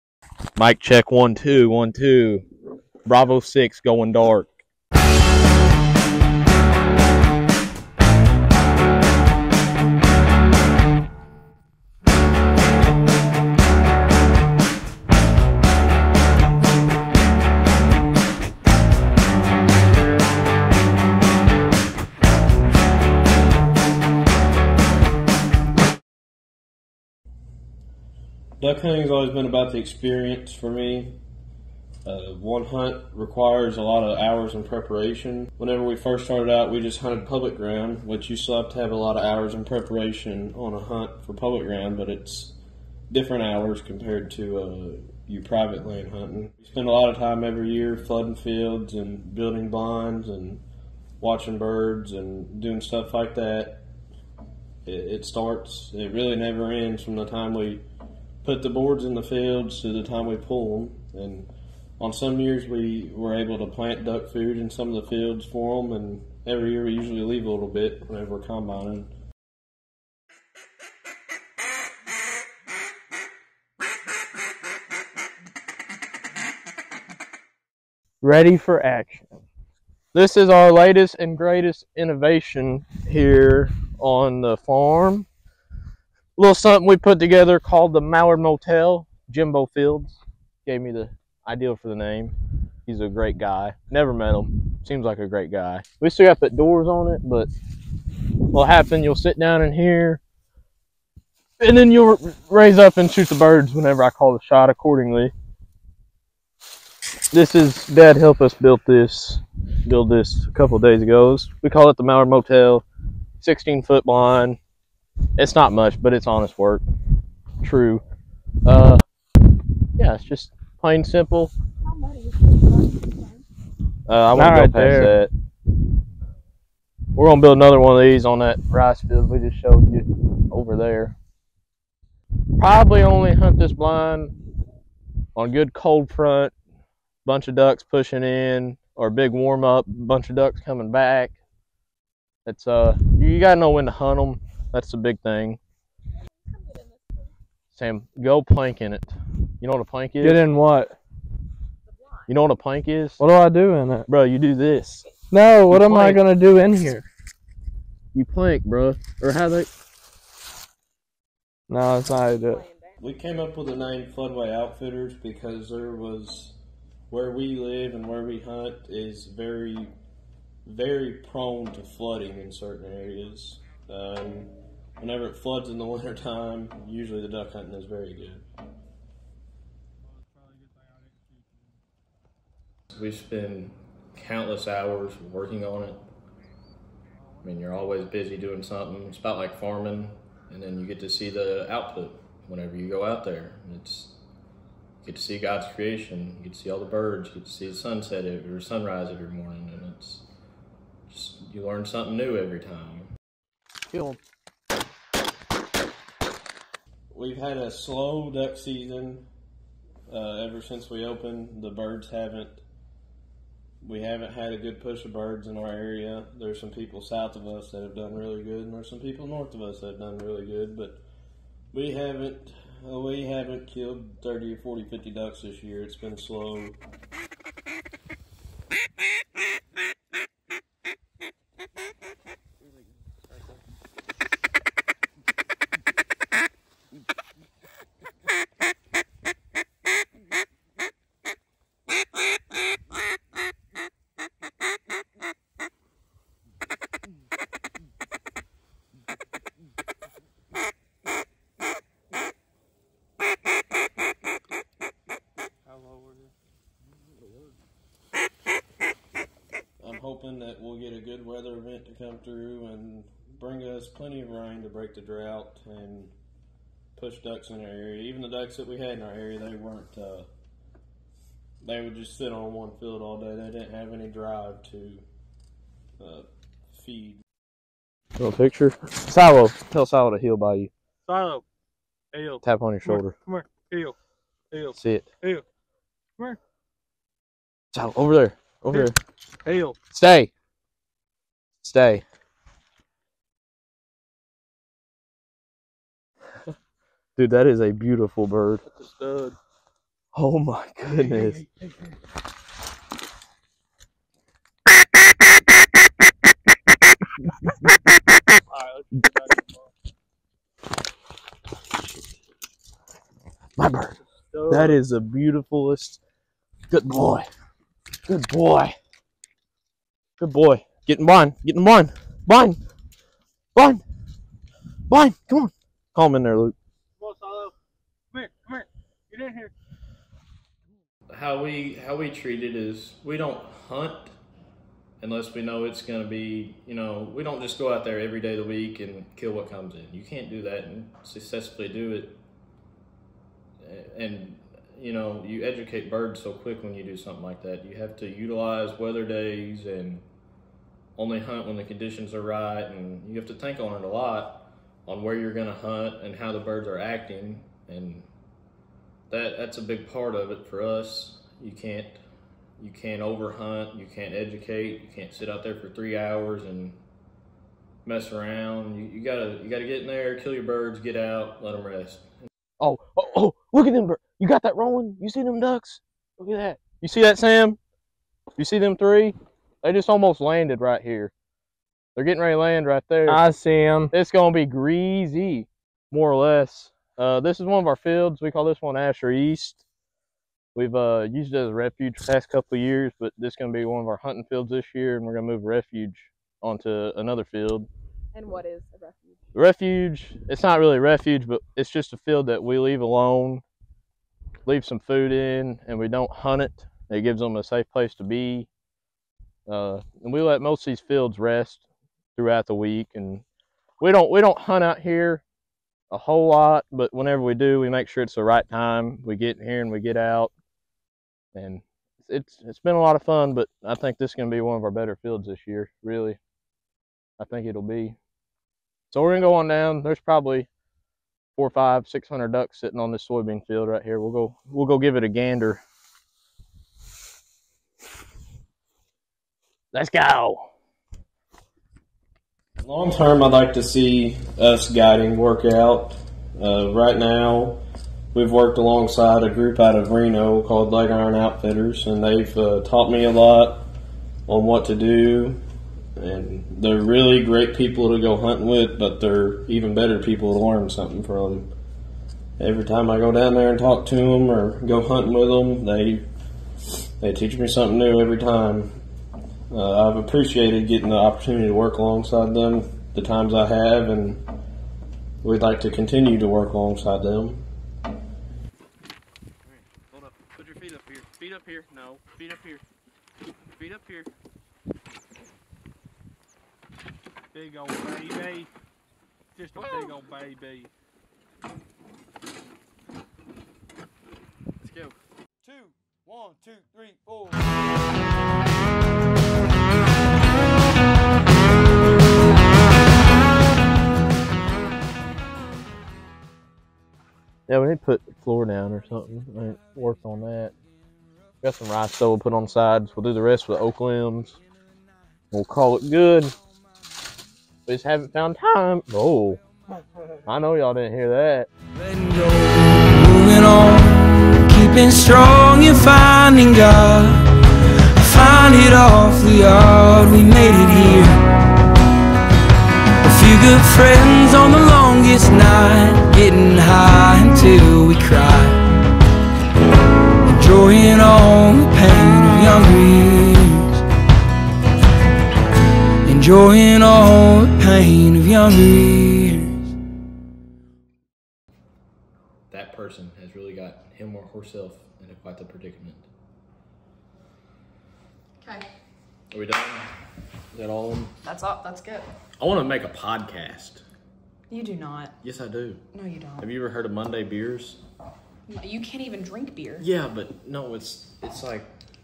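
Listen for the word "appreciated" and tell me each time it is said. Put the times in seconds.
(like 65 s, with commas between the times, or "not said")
469 s.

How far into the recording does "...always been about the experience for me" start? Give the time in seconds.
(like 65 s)
29 s.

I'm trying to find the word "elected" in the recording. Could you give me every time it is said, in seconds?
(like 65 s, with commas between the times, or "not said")
not said.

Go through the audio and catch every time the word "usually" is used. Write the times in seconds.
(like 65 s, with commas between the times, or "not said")
66 s, 176 s.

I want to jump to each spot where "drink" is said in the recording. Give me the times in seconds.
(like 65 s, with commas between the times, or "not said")
569 s.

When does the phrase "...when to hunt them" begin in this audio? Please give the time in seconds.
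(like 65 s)
143 s.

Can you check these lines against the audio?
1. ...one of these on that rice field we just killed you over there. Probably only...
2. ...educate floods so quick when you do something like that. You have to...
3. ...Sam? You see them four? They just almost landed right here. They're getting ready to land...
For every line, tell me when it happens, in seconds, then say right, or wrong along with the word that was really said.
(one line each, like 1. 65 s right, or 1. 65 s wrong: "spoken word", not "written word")
1. 127 s wrong: "showed", not "killed"
2. 345 s wrong: "birds", not "floods"
3. 377 s wrong: "three", not "four".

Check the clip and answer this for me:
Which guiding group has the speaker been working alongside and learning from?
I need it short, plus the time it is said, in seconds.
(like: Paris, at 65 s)
Leg Iron Outfitters, at 450 s.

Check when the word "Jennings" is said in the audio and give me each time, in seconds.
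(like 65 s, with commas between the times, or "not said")
not said.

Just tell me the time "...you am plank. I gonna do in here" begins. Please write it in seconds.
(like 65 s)
155 s.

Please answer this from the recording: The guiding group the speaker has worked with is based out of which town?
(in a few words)
Reno.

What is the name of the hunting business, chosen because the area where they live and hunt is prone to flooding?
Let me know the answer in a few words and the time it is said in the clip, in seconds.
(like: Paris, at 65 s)
Floodway Outfitters, at 164 s.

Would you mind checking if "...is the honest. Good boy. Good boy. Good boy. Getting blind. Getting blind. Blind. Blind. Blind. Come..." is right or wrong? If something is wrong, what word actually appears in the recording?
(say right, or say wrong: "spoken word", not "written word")
wrong: "beautifulest", not "honest".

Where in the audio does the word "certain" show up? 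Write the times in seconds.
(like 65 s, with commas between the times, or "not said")
172 s.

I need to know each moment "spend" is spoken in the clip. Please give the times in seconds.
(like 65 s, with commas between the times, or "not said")
46 s, 183 s.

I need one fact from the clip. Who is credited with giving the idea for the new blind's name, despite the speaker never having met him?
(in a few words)
Jimbo Fields.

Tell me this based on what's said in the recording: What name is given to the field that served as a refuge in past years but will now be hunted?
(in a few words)
Asher East.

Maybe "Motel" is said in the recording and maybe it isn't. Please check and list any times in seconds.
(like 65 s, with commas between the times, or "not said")
88 s, 112 s.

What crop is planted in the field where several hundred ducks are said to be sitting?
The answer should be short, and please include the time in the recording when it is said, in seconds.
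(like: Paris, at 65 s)
soybean, at 433 s.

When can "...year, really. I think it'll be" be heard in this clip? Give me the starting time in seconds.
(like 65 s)
425 s.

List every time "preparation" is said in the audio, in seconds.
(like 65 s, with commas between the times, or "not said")
34 s, 39 s.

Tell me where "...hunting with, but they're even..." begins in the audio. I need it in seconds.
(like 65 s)
458 s.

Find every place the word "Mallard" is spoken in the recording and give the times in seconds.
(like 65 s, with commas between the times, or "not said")
88 s, 112 s.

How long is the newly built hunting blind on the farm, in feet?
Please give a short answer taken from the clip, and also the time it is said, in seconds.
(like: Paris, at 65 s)
16 foot, at 113 s.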